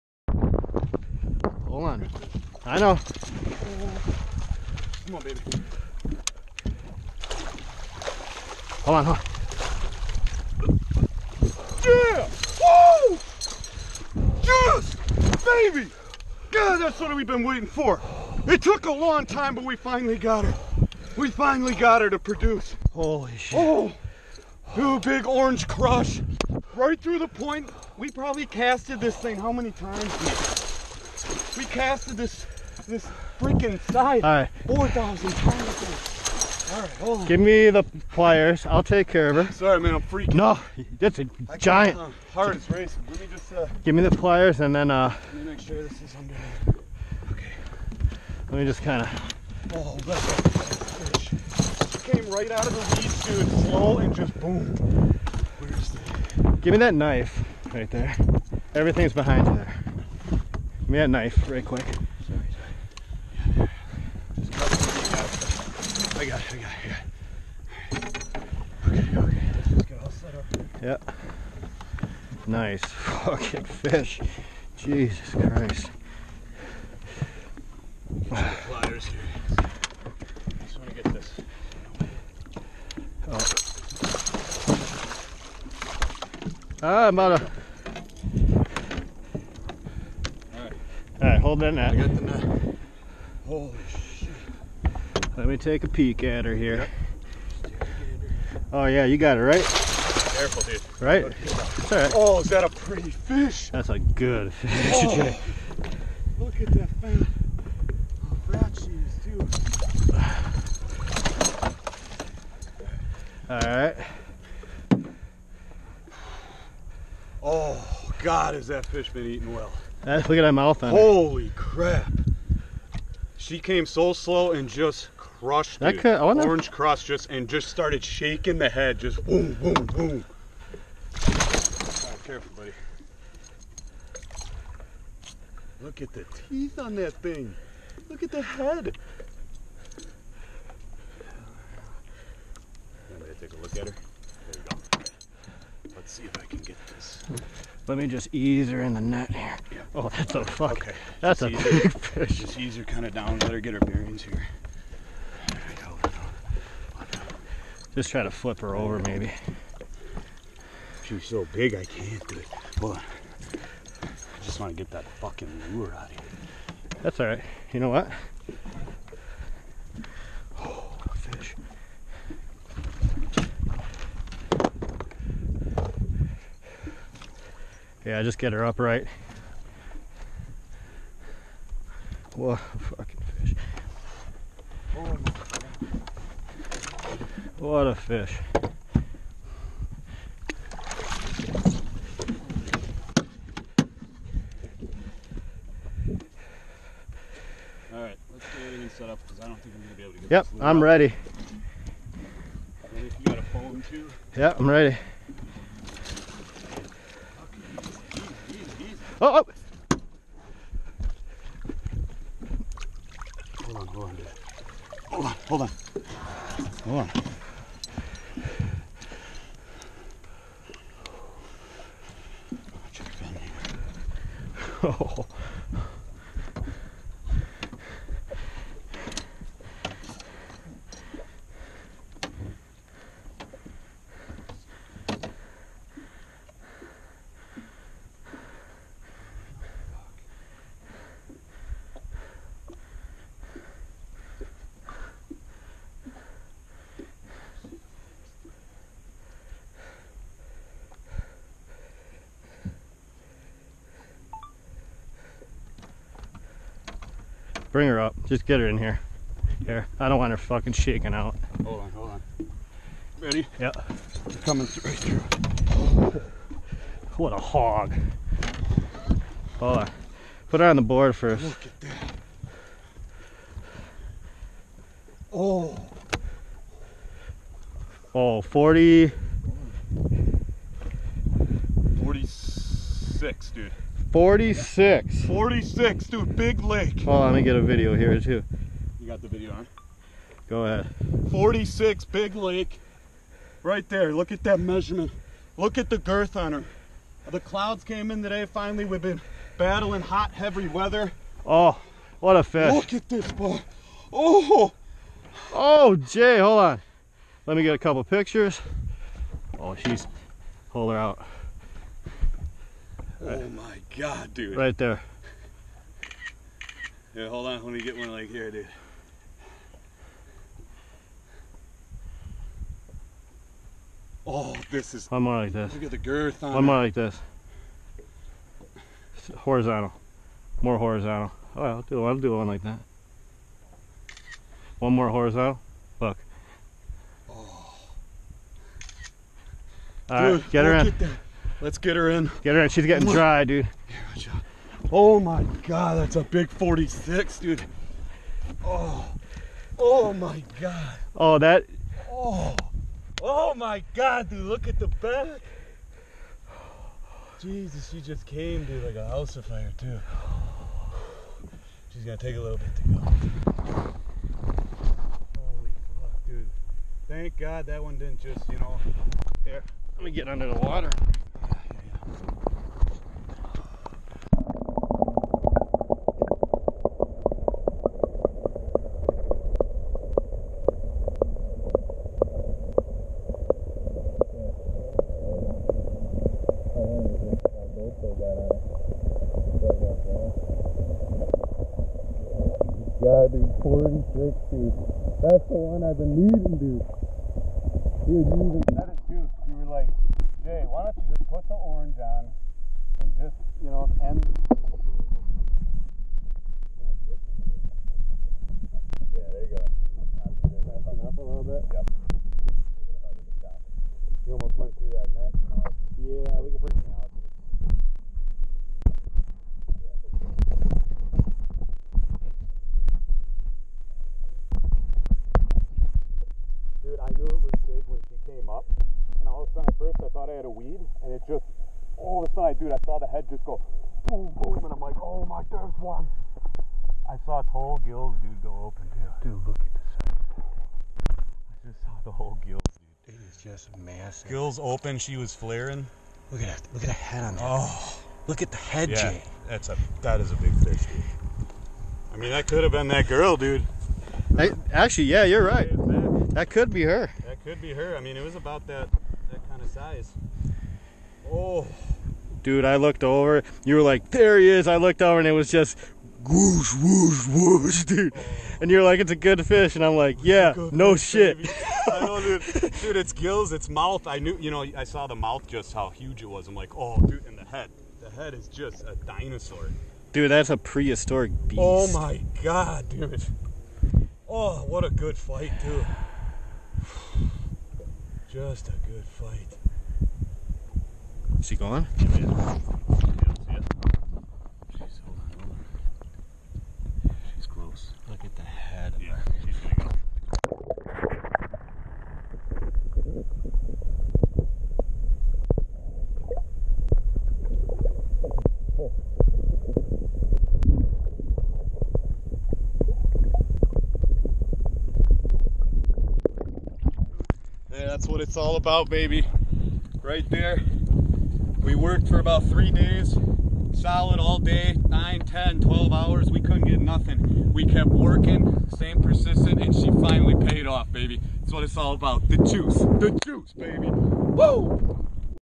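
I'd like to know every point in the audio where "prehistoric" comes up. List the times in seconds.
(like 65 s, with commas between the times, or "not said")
480 s.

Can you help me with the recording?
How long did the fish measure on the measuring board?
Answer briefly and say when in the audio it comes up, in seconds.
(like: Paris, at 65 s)
46, at 285 s.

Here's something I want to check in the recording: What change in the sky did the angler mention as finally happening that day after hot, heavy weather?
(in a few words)
Clouds came in.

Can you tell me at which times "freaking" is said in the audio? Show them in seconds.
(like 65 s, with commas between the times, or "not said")
33 s, 40 s.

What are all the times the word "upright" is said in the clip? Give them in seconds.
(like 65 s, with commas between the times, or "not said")
178 s.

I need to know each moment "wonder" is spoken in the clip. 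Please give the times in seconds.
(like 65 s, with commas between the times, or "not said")
126 s.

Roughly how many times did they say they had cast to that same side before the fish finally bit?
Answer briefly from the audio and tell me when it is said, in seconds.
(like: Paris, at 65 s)
4,000, at 34 s.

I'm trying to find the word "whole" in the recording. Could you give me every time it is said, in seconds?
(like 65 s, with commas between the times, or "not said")
437 s, 442 s.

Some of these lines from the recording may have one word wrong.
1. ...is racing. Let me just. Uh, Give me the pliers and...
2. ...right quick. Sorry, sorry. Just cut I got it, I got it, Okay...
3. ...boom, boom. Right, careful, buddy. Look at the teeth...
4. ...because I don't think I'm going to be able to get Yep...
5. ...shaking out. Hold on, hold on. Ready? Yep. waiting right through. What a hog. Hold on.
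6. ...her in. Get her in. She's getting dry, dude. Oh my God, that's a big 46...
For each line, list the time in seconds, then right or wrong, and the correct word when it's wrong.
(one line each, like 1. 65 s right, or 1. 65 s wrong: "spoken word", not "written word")
1. 42 s right
2. 61 s right
3. 129 s right
4. 199 s right
5. 260 s wrong: "coming", not "waiting"
6. 341 s right.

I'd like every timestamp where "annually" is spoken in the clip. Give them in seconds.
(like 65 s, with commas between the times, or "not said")
not said.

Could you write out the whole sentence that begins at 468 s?
And you're like, it's a good fish.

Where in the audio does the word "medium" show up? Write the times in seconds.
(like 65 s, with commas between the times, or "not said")
not said.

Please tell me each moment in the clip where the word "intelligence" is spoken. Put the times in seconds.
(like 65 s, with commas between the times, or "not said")
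not said.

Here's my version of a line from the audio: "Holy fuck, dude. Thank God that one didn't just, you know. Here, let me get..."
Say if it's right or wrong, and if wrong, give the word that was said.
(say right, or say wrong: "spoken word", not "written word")
right.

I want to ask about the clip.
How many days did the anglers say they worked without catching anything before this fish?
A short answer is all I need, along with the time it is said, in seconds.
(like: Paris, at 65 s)
3, at 522 s.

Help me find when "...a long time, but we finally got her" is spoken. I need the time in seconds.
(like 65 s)
18 s.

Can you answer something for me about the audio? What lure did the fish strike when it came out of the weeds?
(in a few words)
Big orange crush.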